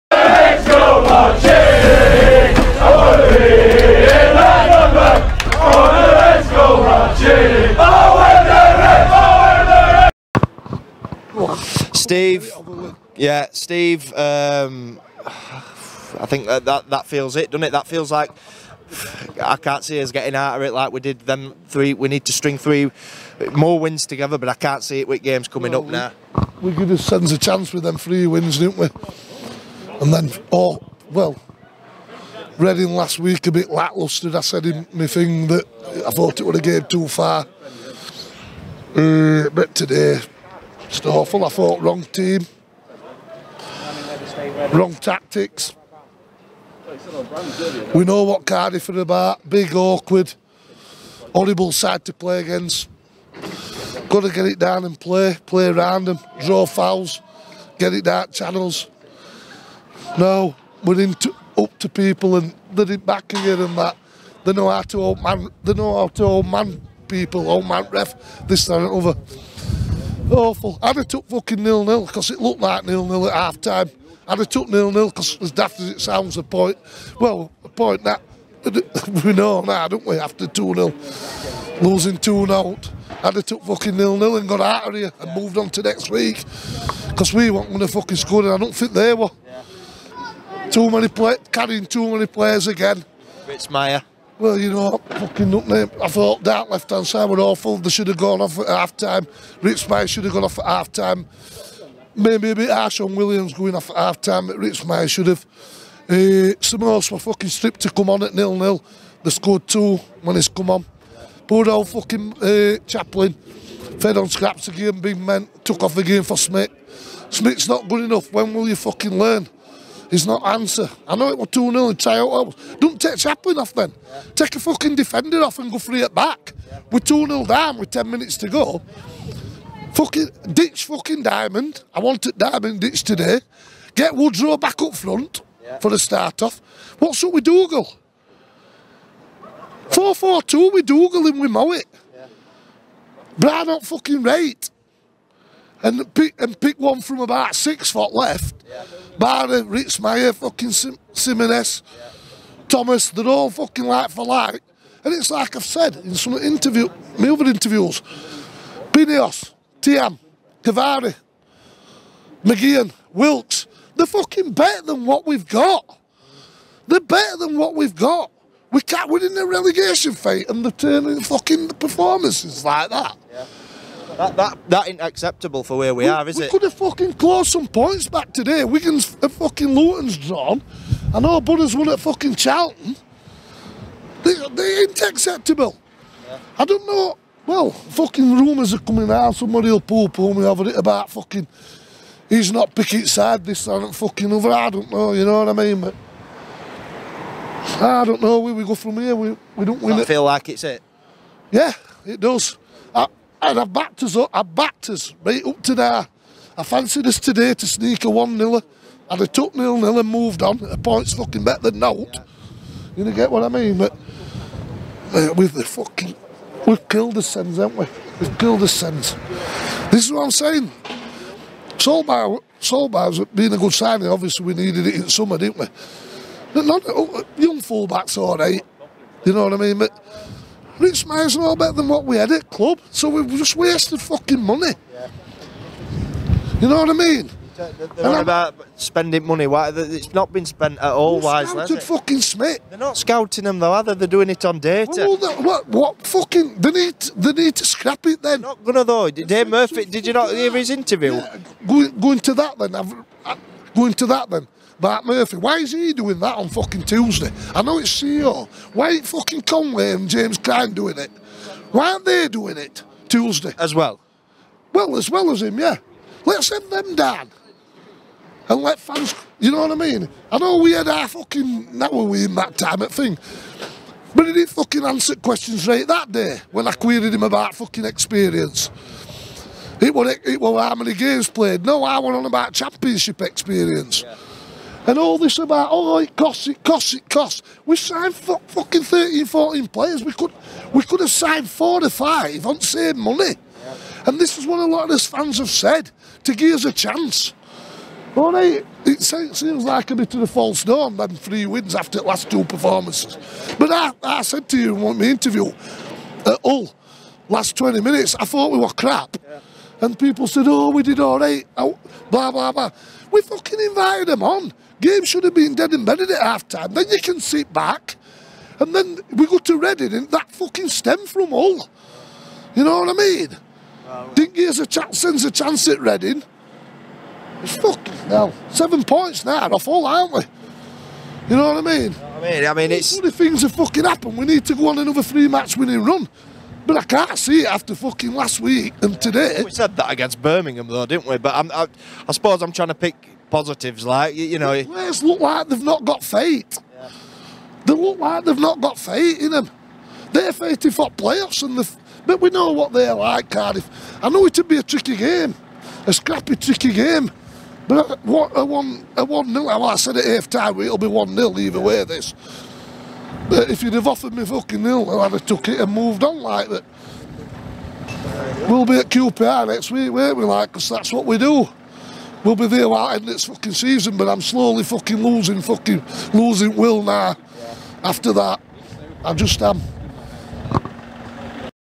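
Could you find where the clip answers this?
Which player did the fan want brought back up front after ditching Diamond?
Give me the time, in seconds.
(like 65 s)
134 s.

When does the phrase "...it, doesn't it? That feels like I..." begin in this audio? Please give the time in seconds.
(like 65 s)
17 s.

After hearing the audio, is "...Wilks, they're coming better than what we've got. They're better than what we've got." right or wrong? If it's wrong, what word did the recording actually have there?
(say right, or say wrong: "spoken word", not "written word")
wrong: "fucking", not "coming".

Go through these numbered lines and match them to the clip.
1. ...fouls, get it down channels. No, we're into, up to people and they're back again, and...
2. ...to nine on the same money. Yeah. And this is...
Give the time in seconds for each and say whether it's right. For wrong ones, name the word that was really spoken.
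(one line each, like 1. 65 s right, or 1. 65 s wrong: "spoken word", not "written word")
1. 56 s right
2. 291 s wrong: "five", not "nine".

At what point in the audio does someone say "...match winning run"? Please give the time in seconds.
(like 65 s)
335 s.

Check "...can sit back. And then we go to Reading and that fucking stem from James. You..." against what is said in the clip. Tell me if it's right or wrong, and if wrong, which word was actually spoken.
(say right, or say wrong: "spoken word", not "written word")
wrong: "Hull", not "James".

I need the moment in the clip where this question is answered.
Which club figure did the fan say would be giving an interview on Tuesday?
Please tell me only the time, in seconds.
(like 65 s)
249 s.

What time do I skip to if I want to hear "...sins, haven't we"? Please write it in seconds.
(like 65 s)
217 s.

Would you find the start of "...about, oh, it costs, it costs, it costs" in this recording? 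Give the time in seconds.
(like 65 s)
285 s.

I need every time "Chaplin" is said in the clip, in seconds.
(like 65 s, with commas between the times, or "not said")
112 s, 123 s.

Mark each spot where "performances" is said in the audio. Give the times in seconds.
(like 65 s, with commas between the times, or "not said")
171 s, 302 s.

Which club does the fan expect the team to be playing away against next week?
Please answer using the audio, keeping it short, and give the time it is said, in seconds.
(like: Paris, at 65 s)
QPR, at 368 s.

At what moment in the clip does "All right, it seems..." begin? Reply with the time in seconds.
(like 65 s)
298 s.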